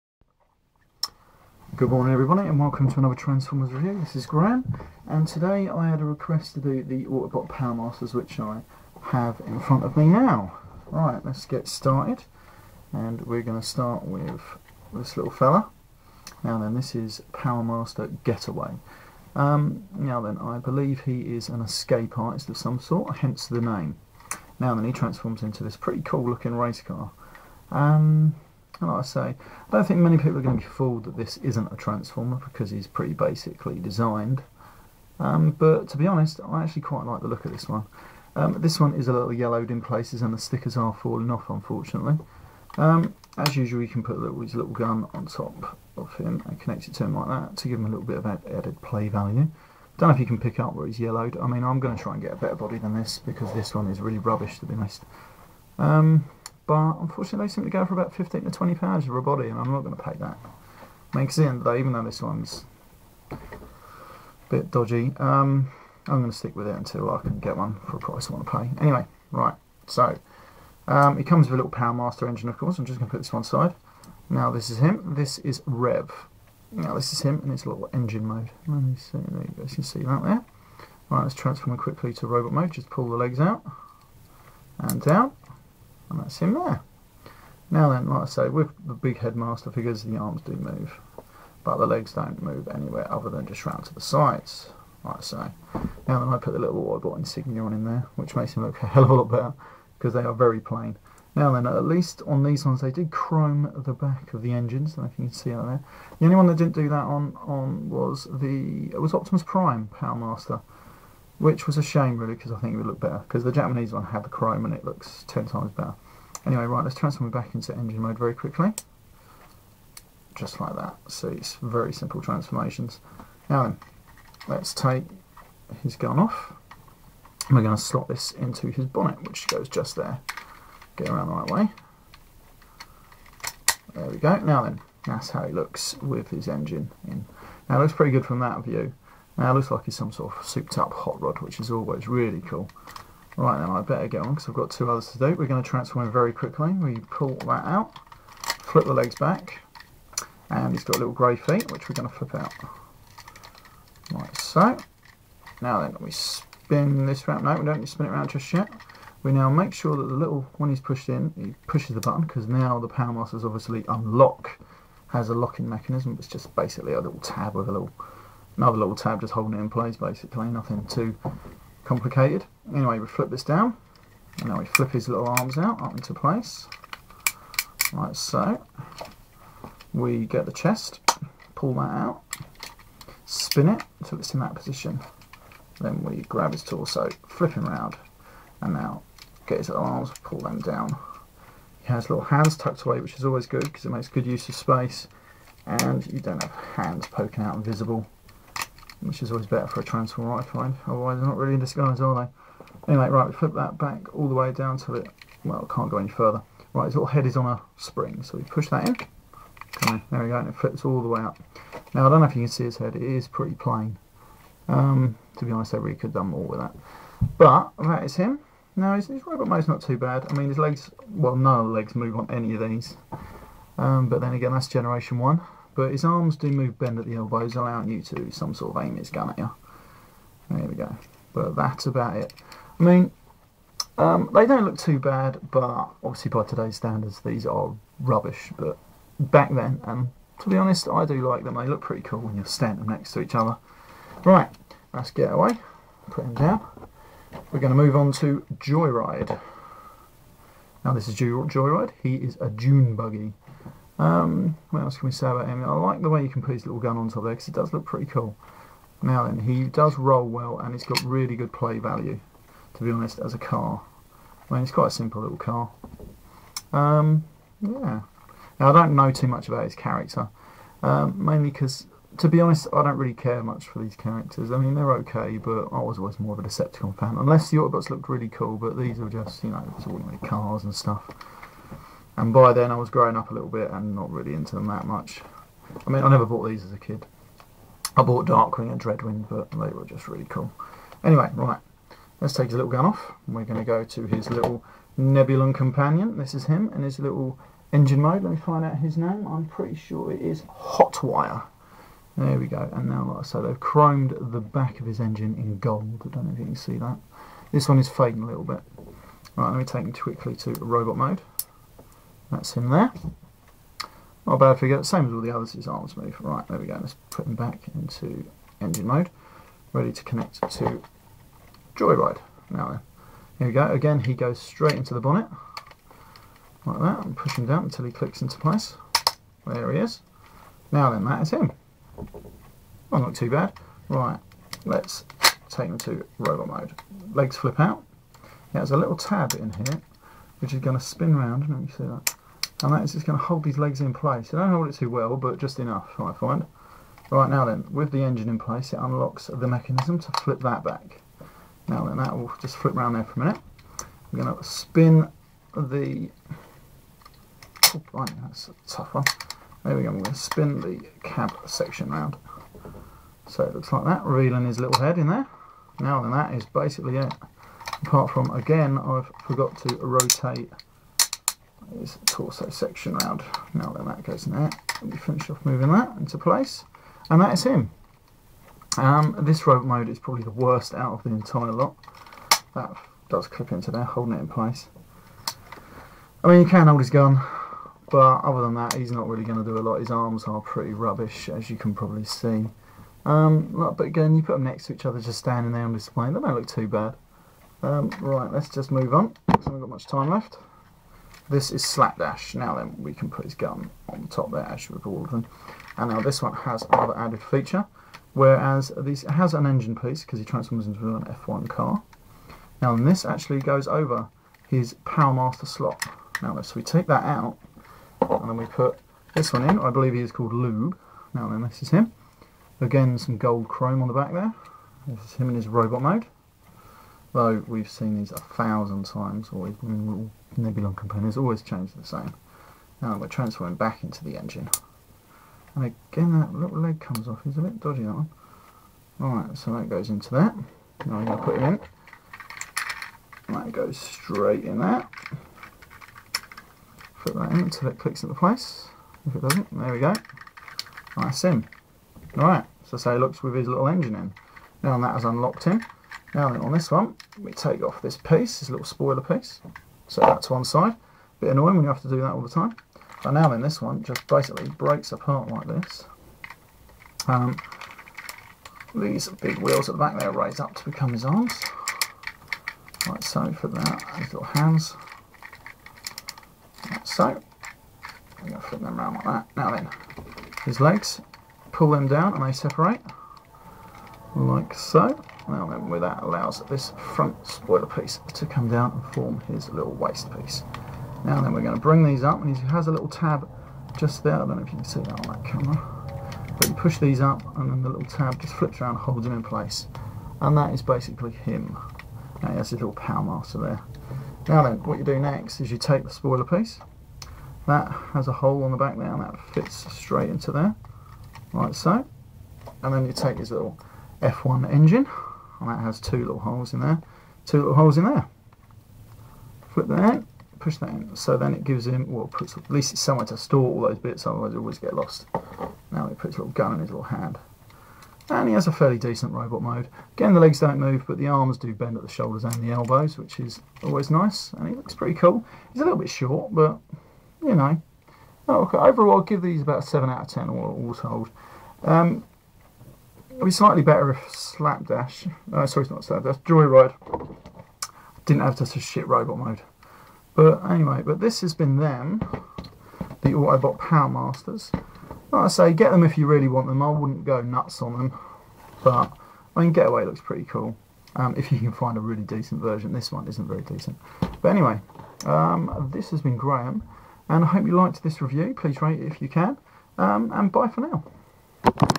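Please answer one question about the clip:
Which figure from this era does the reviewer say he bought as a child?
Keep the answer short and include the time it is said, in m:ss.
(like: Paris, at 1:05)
Darkwing, at 4:48.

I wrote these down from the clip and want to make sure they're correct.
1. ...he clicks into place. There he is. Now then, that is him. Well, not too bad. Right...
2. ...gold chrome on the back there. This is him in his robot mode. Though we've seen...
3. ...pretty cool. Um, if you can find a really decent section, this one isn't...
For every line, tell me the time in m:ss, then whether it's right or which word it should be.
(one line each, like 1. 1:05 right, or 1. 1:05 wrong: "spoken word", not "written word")
1. 5:27 right
2. 7:03 right
3. 9:20 wrong: "version", not "section".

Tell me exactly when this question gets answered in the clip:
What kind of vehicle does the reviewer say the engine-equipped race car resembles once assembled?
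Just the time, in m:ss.
2:20.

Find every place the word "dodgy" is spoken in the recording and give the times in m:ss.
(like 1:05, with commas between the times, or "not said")
1:04, 7:17.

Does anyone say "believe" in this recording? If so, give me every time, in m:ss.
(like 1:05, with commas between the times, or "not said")
0:20, 6:59.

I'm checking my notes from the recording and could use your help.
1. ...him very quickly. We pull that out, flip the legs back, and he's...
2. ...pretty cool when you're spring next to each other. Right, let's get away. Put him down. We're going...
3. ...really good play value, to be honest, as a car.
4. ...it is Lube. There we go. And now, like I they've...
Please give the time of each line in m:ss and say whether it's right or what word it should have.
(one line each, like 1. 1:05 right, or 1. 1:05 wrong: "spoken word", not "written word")
1. 2:26 right
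2. 4:01 wrong: "standing", not "spring"
3. 4:21 right
4. 5:00 wrong: "Hotwire", not "Lube".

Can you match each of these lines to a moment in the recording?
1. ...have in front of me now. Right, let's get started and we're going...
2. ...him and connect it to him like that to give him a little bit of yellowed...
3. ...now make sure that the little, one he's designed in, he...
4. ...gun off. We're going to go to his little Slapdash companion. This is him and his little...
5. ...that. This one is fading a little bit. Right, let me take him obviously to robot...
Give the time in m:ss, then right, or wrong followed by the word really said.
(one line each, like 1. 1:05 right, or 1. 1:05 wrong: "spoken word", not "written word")
1. 0:09 right
2. 0:46 wrong: "added", not "yellowed"
3. 2:39 wrong: "pushed", not "designed"
4. 4:52 wrong: "Nebulon", not "Slapdash"
5. 5:06 wrong: "quickly", not "obviously".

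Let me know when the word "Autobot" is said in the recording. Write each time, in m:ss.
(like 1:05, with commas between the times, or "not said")
0:07, 1:36, 4:37, 9:13.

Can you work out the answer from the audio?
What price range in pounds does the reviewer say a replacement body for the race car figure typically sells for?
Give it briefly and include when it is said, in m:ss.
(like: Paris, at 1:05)
15 to 20 pounds, at 0:58.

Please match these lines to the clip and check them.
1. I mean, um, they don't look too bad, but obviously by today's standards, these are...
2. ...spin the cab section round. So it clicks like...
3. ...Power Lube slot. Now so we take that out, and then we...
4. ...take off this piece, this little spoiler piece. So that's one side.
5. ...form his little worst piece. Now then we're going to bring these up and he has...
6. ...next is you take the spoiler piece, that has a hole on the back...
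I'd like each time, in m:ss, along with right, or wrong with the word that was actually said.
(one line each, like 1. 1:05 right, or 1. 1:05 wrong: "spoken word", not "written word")
1. 3:52 right
2. 6:00 wrong: "looks", not "clicks"
3. 6:54 wrong: "Master", not "Lube"
4. 7:37 right
5. 8:08 wrong: "waist", not "worst"
6. 8:24 right.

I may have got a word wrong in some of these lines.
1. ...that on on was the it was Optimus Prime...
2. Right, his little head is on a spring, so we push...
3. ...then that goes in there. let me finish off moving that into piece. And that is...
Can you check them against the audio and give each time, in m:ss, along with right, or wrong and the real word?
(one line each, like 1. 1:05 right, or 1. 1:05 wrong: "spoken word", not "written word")
1. 1:46 right
2. 3:26 right
3. 6:13 wrong: "place", not "piece".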